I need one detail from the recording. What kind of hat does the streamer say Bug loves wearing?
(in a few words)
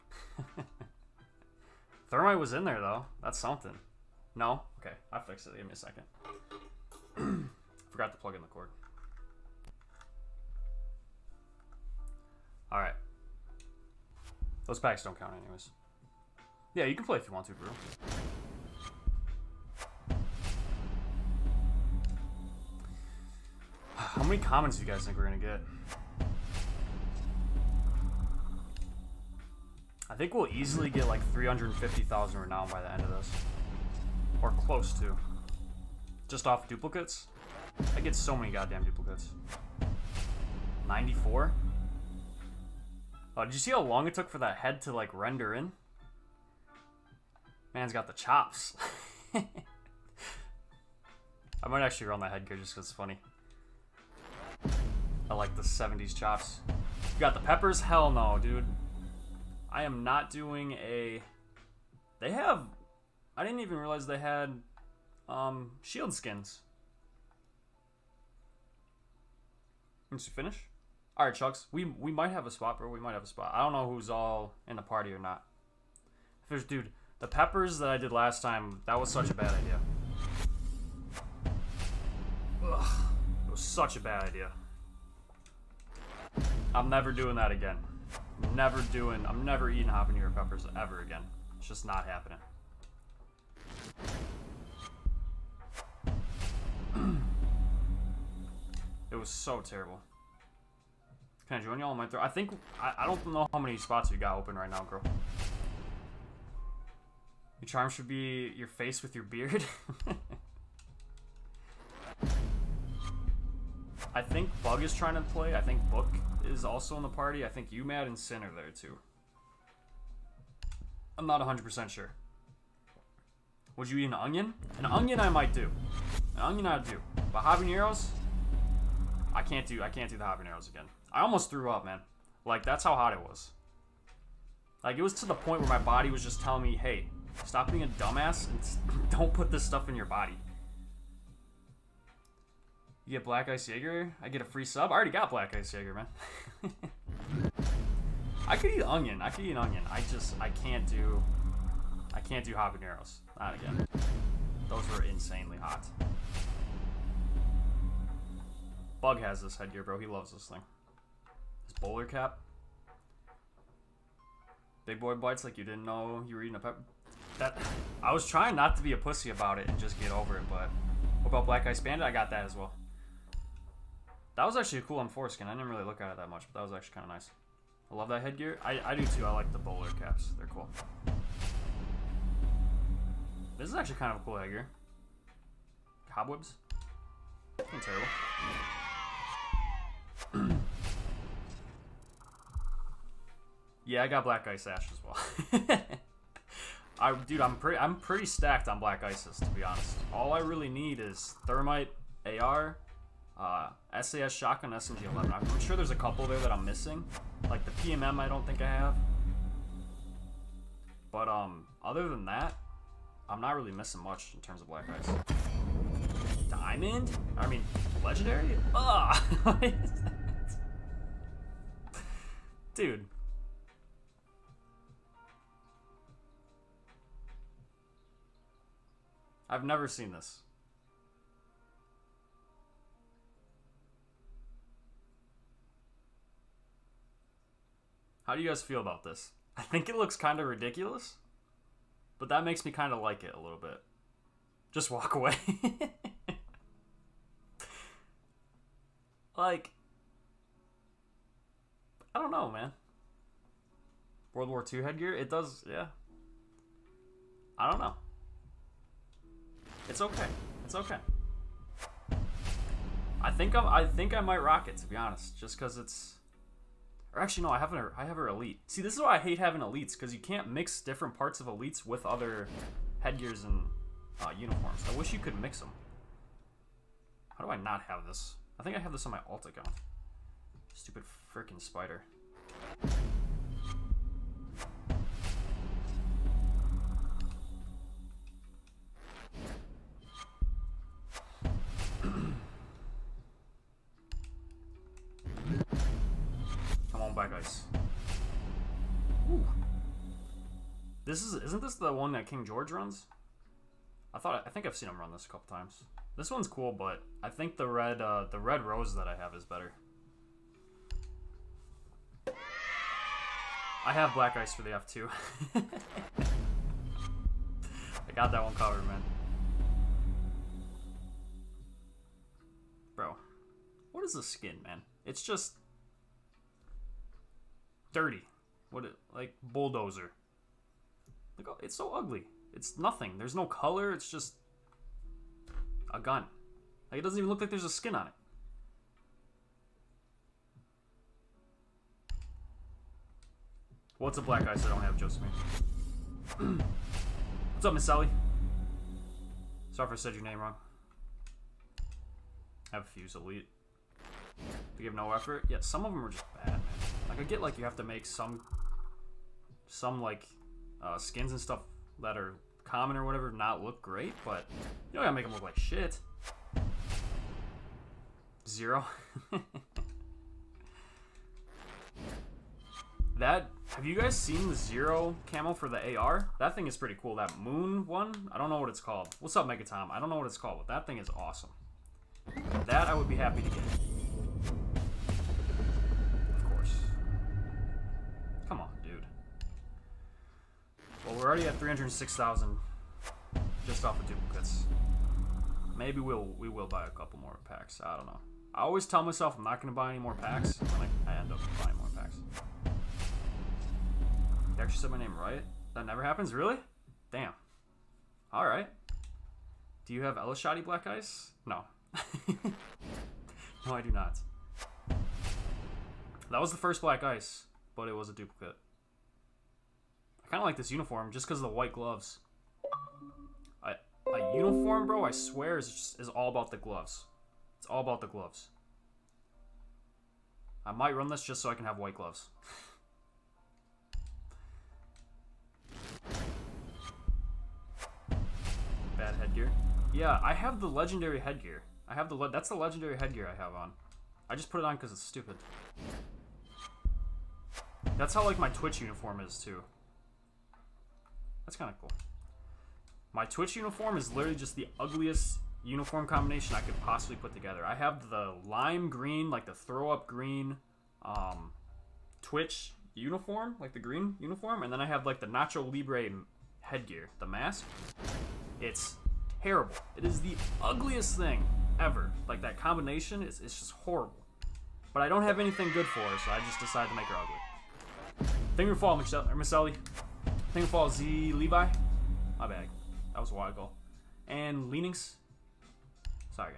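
Bowler cap.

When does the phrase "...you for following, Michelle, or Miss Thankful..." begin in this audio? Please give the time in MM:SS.
07:58.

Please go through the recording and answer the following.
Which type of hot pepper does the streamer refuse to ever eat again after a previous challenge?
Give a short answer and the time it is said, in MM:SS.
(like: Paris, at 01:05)
Habanero, at 01:29.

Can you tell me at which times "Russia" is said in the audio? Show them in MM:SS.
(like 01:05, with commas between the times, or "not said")
not said.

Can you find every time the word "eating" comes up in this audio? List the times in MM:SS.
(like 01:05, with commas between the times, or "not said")
01:29, 02:46.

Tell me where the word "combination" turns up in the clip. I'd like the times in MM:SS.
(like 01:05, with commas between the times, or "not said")
07:36, 07:52.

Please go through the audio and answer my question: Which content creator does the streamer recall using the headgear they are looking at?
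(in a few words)
King George.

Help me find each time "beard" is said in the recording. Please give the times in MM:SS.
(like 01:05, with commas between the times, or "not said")
01:49.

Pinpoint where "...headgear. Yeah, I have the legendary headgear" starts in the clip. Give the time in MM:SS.
07:19.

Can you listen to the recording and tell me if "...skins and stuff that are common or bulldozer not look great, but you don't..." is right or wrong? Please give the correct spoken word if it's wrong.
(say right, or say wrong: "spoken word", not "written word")
wrong: "whatever", not "bulldozer".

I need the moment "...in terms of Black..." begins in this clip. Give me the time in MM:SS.
03:34.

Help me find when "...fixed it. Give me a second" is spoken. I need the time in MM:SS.
00:05.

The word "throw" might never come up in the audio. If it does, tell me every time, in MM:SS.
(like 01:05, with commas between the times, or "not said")
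01:42, 07:39.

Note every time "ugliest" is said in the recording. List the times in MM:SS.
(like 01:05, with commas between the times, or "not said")
07:34, 07:50.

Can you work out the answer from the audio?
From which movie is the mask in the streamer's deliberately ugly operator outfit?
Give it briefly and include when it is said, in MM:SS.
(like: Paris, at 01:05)
Nacho Libre, at 07:45.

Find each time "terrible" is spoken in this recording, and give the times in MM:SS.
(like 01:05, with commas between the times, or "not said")
01:39, 03:07, 07:49.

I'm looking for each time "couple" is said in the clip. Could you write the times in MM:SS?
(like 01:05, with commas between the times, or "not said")
03:25, 05:05, 06:36.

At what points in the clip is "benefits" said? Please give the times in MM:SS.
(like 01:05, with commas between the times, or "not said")
not said.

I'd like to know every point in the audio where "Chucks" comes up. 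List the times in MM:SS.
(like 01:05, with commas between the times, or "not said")
01:11.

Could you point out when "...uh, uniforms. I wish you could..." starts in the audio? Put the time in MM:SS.
04:34.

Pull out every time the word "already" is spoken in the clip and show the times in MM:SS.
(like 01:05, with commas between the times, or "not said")
02:24, 06:31.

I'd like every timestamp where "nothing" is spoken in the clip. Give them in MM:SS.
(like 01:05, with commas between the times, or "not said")
05:32.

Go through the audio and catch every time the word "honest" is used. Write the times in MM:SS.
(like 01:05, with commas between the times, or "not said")
03:19, 04:24.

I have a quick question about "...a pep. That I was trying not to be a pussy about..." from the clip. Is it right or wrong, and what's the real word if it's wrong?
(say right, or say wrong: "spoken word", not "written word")
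right.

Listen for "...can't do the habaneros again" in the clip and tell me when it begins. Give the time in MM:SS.
02:09.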